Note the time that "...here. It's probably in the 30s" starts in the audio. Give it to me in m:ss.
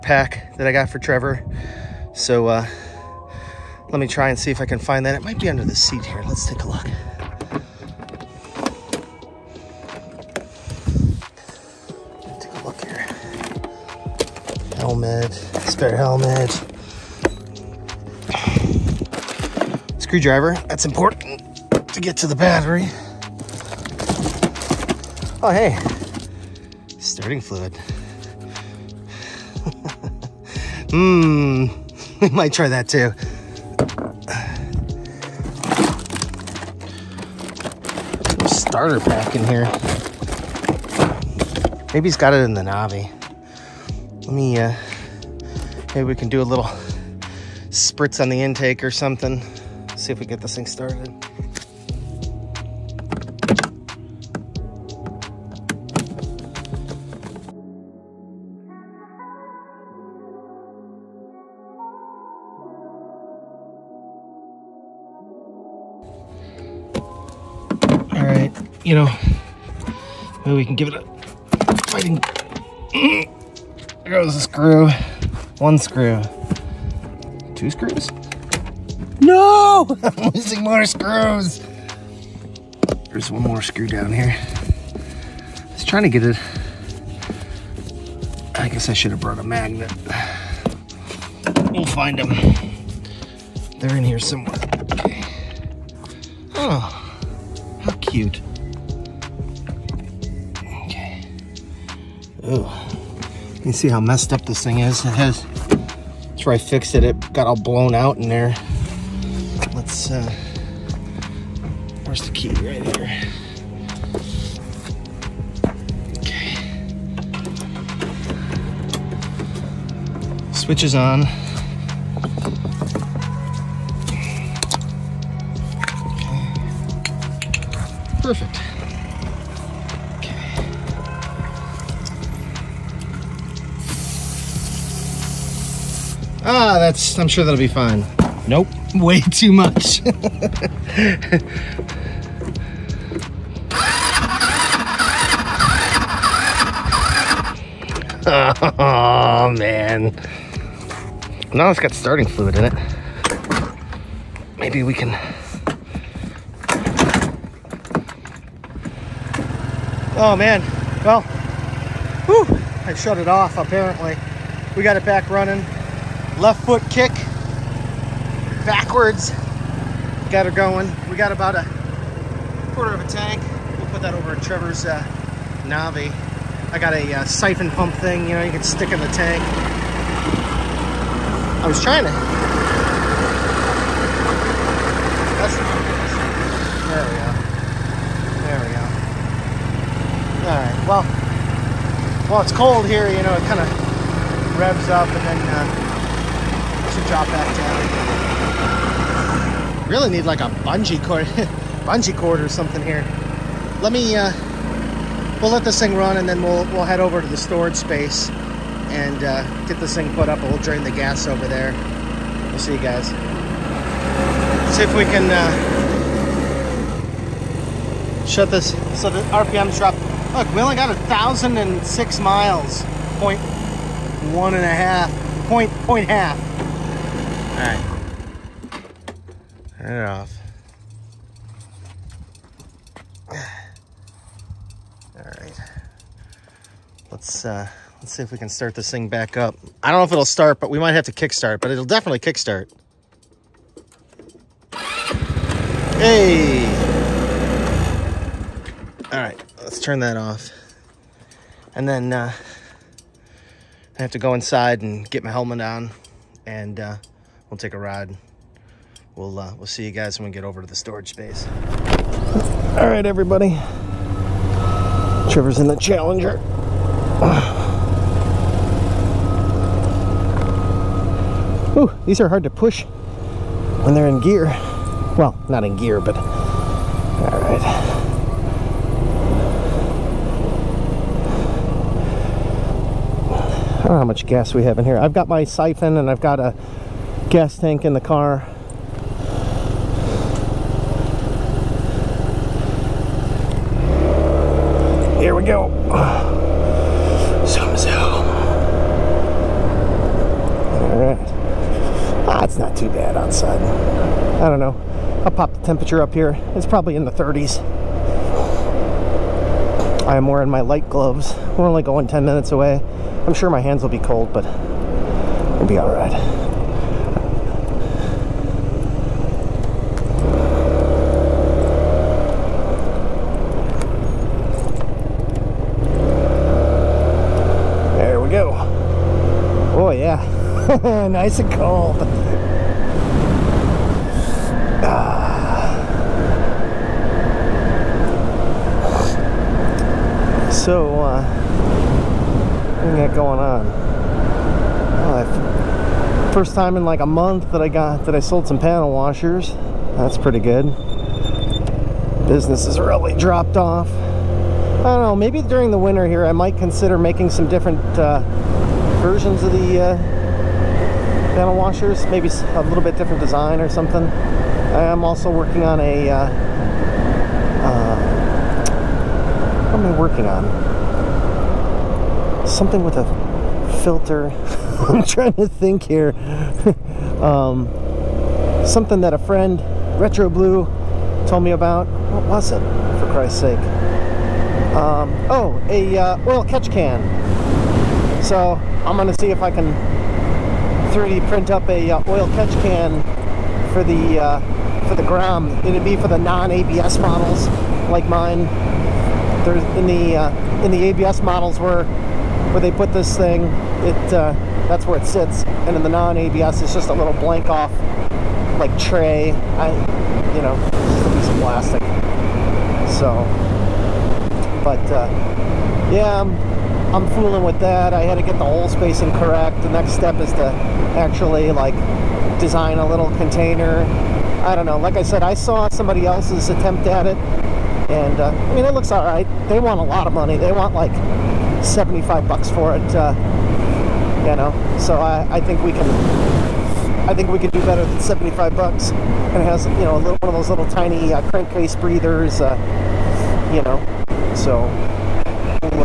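5:06.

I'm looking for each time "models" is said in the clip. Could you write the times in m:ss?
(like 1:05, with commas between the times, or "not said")
6:36, 6:41.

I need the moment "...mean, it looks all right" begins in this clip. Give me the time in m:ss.
7:08.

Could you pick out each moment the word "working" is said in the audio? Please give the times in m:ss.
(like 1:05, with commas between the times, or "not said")
6:05, 6:09.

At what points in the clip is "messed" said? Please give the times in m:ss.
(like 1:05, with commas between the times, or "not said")
1:44.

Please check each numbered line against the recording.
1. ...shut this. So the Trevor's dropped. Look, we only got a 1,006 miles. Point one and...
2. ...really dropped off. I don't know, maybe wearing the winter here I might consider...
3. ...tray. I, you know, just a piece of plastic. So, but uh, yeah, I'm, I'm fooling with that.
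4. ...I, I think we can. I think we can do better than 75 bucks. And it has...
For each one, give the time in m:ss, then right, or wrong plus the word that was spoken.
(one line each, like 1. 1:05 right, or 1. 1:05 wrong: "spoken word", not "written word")
1. 3:38 wrong: "RPM", not "Trevor"
2. 5:52 wrong: "during", not "wearing"
3. 6:48 right
4. 7:14 right.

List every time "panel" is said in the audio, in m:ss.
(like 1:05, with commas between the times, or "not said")
5:48, 6:01.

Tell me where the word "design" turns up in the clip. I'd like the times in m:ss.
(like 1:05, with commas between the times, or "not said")
6:03, 7:02.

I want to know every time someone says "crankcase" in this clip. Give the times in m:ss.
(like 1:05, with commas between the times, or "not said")
7:21.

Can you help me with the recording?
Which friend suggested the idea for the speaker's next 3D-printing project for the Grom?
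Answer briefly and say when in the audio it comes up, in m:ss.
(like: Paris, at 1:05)
Retro Blue, at 6:19.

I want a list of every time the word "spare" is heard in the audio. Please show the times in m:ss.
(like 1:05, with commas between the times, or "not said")
0:15.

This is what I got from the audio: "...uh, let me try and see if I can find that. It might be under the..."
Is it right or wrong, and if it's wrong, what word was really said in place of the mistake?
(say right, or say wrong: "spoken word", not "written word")
right.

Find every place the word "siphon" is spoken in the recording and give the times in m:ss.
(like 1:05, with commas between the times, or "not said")
2:57, 4:45.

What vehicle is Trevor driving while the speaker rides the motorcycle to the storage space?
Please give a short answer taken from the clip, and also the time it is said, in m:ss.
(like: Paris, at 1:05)
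Challenger, at 4:25.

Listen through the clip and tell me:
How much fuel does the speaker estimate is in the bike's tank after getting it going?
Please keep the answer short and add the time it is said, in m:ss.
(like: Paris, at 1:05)
a quarter of a tank, at 2:51.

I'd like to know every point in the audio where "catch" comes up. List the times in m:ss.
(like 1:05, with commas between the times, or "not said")
6:26, 6:32.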